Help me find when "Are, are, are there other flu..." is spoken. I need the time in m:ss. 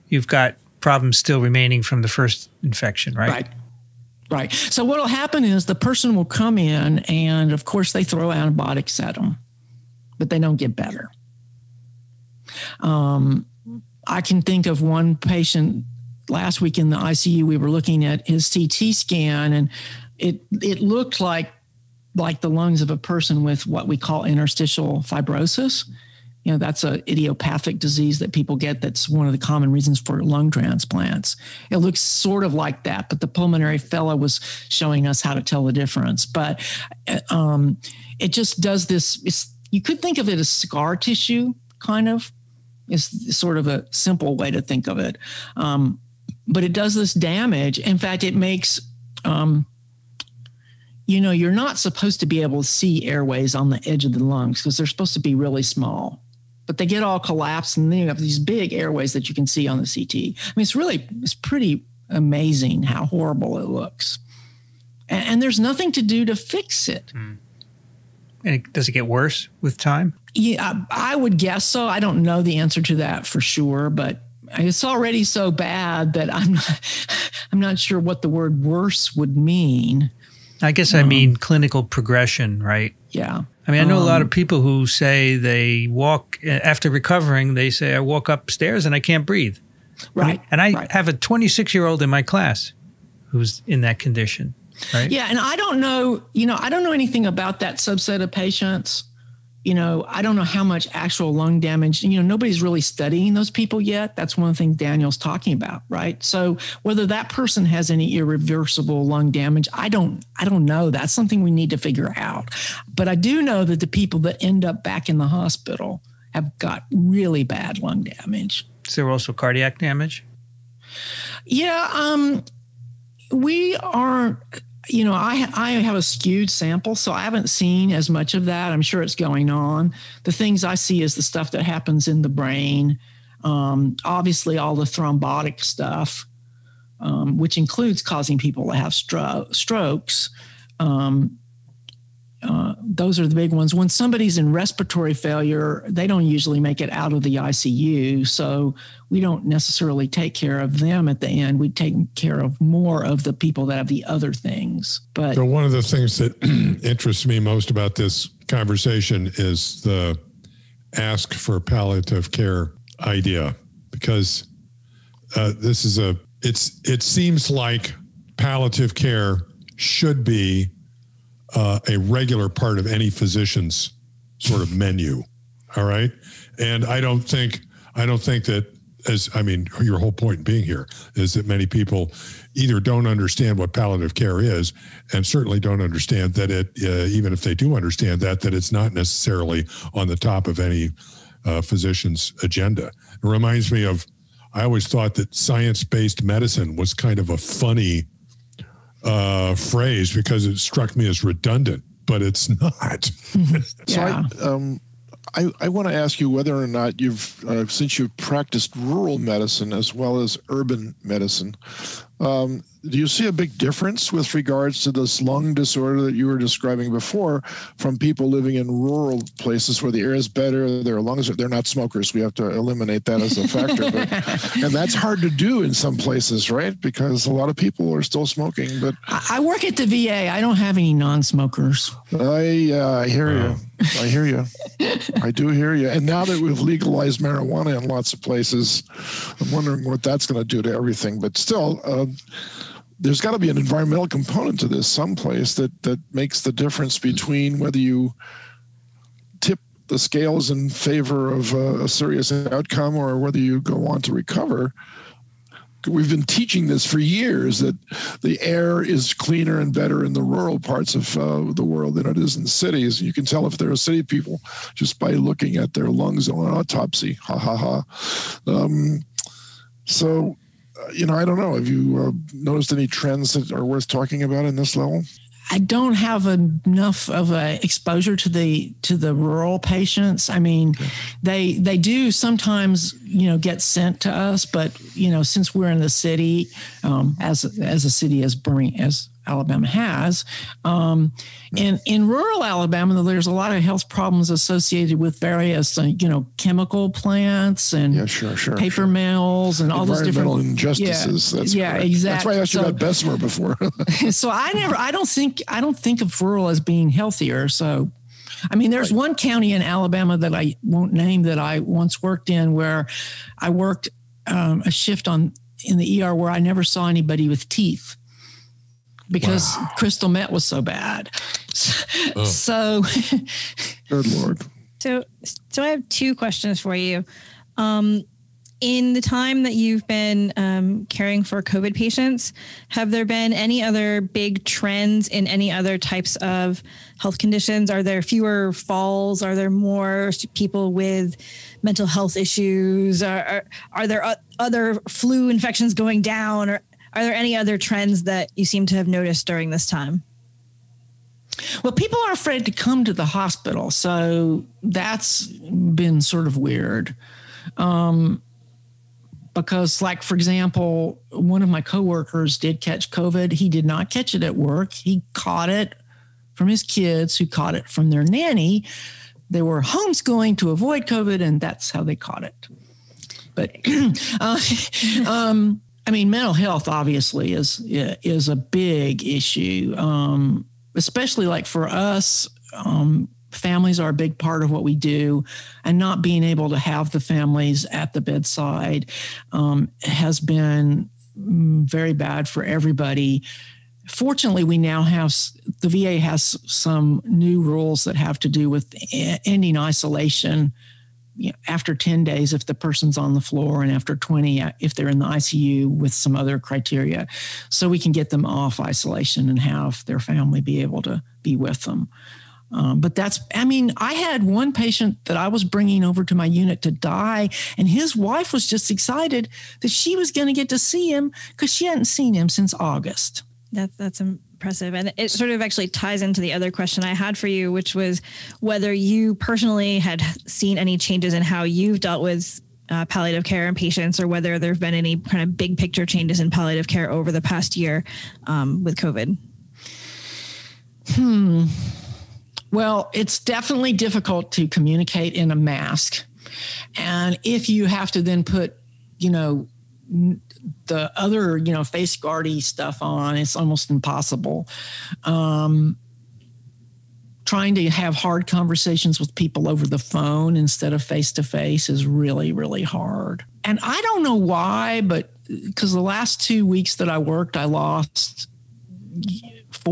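5:43.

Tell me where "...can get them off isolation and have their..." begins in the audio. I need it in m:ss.
6:47.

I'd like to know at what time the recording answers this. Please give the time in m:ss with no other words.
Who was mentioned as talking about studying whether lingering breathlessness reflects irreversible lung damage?
1:44.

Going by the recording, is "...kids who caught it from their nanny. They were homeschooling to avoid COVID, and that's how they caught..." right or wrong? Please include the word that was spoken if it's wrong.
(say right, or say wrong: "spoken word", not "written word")
right.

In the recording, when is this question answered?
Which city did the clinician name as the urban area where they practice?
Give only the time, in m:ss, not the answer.
4:48.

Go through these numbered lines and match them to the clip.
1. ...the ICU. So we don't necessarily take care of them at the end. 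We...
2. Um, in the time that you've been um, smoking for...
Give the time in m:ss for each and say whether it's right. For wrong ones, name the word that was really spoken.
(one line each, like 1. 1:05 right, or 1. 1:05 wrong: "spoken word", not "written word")
1. 2:27 right
2. 5:27 wrong: "caring", not "smoking".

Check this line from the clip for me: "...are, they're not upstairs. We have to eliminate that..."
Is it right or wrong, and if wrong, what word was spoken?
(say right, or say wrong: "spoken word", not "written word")
wrong: "smokers", not "upstairs".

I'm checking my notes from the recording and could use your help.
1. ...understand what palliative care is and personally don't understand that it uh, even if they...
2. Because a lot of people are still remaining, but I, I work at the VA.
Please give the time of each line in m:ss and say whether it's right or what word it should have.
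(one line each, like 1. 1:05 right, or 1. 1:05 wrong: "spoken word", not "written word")
1. 3:03 wrong: "certainly", not "personally"
2. 3:46 wrong: "smoking", not "remaining".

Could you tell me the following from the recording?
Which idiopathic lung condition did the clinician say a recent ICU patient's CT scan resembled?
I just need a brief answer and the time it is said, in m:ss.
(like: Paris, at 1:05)
interstitial fibrosis, at 0:24.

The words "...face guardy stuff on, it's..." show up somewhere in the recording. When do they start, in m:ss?
7:31.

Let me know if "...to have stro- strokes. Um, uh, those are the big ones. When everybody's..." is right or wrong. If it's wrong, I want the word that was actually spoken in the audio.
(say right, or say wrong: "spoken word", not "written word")
wrong: "somebody", not "everybody".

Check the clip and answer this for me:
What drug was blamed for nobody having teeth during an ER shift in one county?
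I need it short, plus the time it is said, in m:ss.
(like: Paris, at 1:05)
crystal meth, at 5:19.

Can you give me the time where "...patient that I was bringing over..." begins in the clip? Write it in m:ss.
6:54.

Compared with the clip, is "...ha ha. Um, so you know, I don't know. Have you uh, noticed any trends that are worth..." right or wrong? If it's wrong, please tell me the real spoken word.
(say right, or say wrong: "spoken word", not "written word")
right.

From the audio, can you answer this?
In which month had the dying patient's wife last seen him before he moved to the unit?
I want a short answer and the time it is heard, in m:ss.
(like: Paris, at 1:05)
August, at 7:02.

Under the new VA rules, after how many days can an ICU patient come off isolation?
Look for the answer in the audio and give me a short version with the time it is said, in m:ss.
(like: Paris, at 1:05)
20, at 6:43.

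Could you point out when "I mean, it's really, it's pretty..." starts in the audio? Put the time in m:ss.
1:00.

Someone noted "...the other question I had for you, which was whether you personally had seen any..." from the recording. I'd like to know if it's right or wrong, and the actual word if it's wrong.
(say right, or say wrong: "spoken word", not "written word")
right.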